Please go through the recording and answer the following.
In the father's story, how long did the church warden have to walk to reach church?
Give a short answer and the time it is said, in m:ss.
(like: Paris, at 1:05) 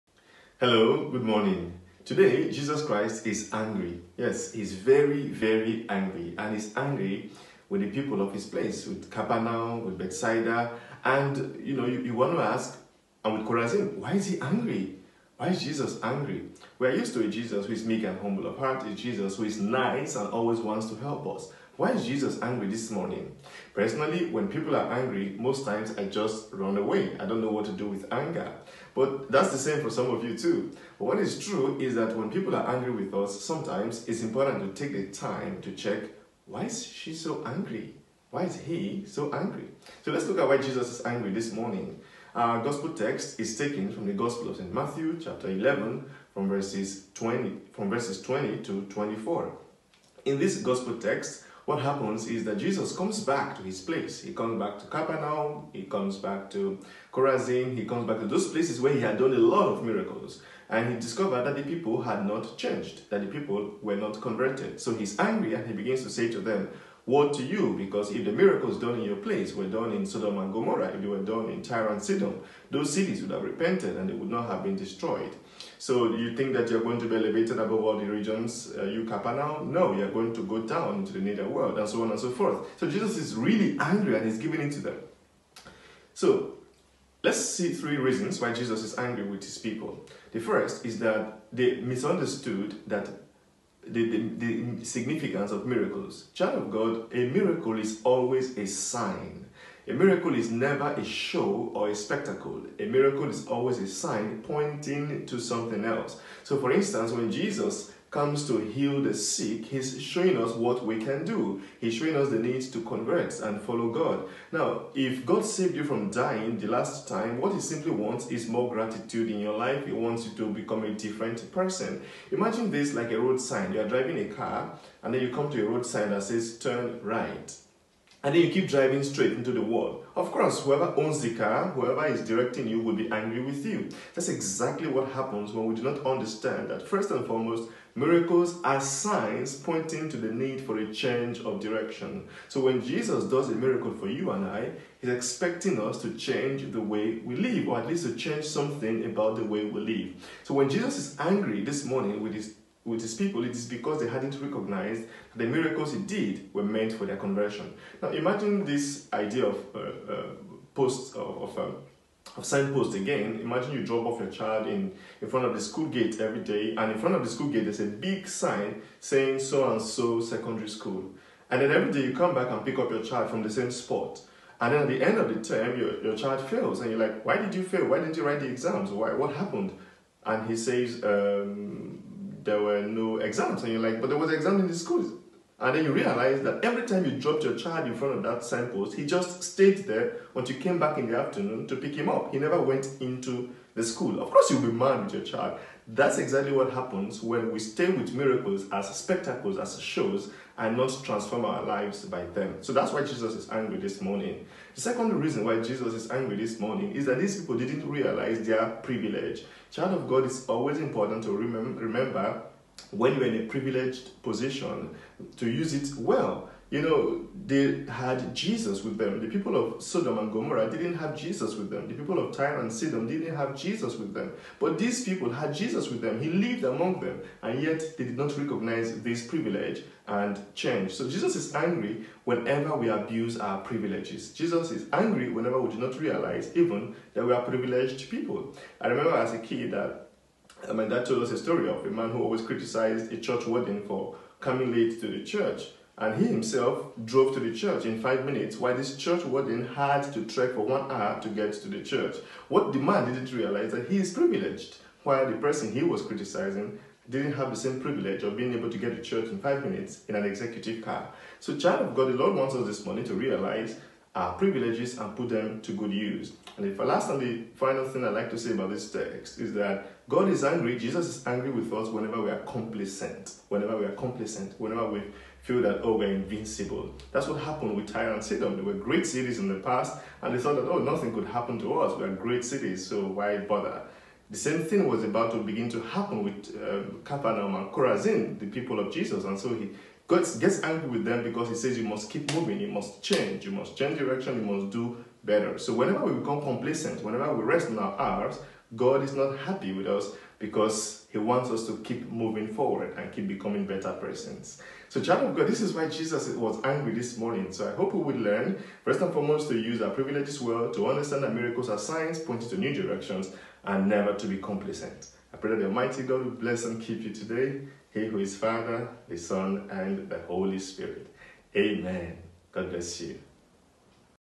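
one hour, at 4:10.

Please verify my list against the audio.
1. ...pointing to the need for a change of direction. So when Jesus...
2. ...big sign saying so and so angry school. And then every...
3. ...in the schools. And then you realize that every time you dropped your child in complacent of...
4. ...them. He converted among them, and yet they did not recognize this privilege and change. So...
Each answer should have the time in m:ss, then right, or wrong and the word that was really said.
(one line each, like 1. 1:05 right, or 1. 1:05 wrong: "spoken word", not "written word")
1. 2:19 right
2. 2:47 wrong: "secondary", not "angry"
3. 3:04 wrong: "front", not "complacent"
4. 3:45 wrong: "lived", not "converted".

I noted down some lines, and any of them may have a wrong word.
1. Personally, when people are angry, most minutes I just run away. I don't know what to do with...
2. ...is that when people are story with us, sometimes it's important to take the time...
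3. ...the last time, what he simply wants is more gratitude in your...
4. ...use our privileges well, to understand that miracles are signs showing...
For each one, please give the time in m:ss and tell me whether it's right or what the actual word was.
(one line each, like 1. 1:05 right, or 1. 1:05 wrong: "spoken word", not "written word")
1. 0:23 wrong: "times", not "minutes"
2. 0:31 wrong: "angry", not "story"
3. 1:56 right
4. 5:09 wrong: "pointing", not "showing".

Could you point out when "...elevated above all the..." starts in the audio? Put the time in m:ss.
1:17.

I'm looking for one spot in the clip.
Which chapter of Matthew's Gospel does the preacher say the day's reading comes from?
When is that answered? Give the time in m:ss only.
0:45.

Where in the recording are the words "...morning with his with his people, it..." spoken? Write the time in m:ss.
2:31.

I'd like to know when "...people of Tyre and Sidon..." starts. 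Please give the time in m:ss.
3:41.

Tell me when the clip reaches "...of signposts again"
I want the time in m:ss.
2:42.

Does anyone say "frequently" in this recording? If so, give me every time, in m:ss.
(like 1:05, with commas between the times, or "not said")
not said.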